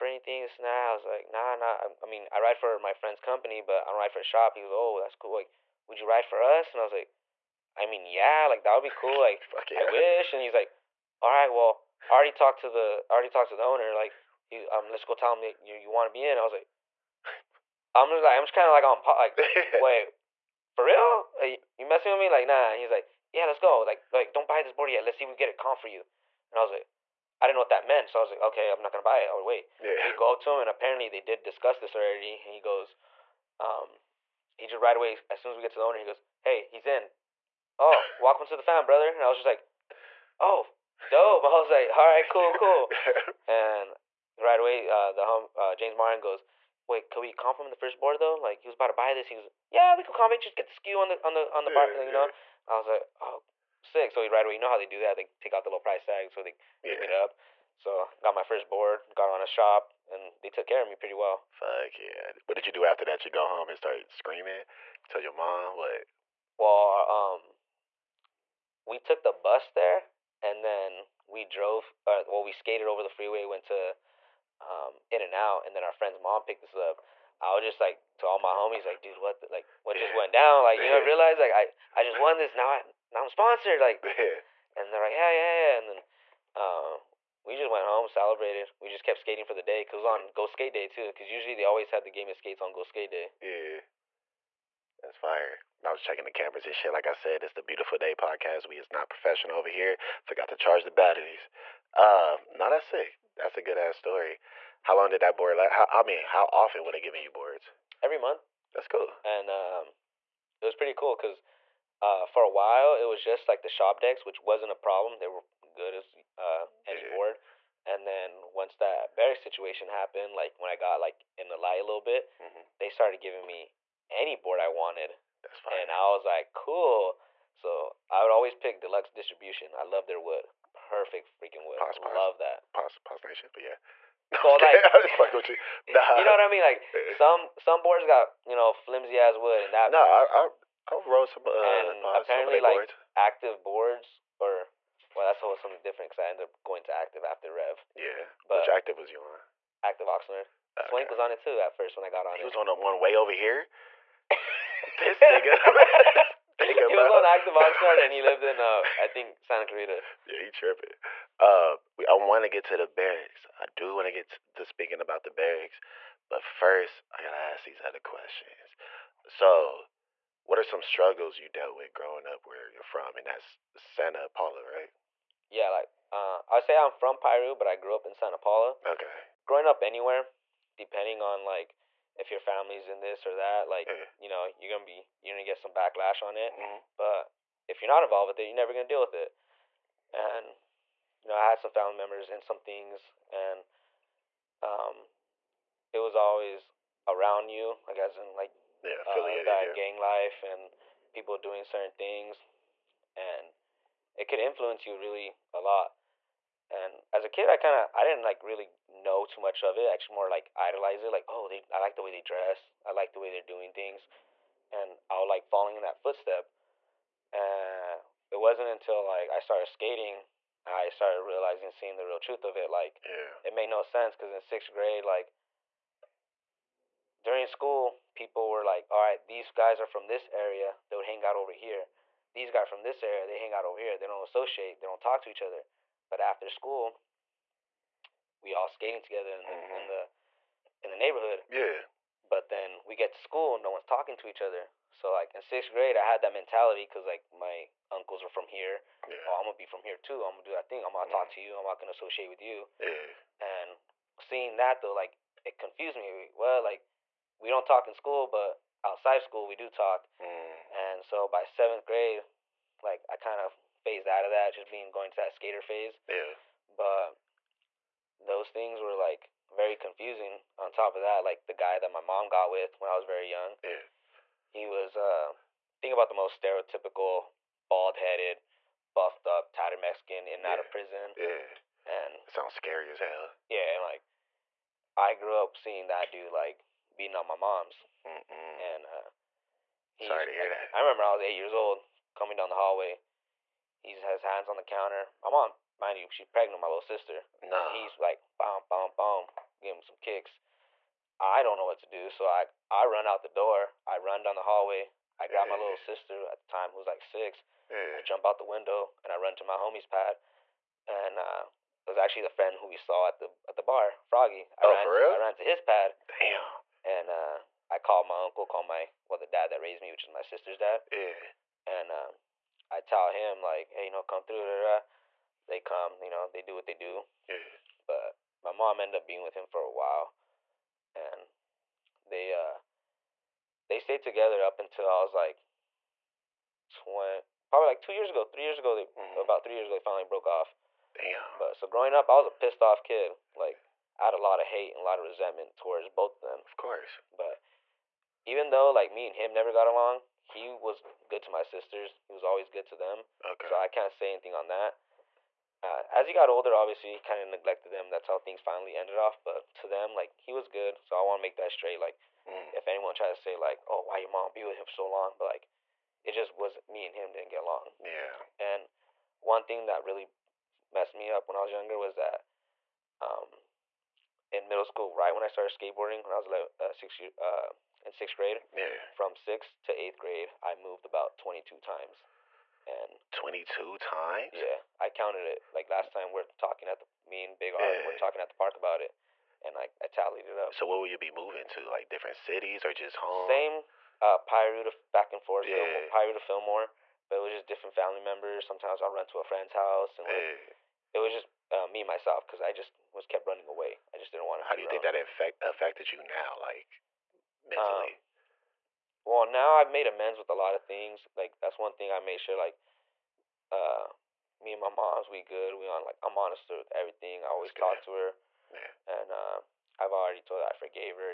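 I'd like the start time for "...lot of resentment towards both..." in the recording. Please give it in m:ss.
5:44.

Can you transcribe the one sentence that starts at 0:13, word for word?
Like, he, um, let's go tell him that you, you want to be in.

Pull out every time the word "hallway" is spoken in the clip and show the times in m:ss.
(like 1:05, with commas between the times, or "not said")
4:52, 5:04.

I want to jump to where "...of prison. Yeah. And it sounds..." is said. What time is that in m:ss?
4:40.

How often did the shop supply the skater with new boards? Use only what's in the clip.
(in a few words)
Every month.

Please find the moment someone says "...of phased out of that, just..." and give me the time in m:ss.
4:23.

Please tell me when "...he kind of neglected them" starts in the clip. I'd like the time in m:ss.
5:56.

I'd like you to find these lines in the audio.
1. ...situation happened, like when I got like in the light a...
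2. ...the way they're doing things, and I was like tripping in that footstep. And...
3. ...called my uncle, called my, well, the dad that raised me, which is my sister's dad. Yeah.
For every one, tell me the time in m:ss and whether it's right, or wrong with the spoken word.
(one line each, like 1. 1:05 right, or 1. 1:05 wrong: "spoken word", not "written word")
1. 1:59 right
2. 3:33 wrong: "falling", not "tripping"
3. 5:17 right.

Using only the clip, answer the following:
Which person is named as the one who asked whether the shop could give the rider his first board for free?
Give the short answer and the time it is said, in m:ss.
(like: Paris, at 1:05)
James Martin, at 0:45.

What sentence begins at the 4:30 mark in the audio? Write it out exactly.
On top of that, like the guy that my mom got with when I was very young.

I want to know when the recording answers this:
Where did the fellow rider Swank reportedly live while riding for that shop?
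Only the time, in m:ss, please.
2:39.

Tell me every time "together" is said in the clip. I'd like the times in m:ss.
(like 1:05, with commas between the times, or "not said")
3:59, 5:34.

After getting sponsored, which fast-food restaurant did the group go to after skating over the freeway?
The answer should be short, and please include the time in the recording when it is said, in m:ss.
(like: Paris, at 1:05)
In-N-Out, at 1:15.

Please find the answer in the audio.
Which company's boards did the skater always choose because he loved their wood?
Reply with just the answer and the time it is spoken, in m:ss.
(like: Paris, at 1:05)
Deluxe Distribution, at 2:08.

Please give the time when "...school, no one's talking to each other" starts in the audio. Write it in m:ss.
4:03.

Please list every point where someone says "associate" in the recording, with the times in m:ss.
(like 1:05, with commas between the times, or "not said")
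3:54, 4:11.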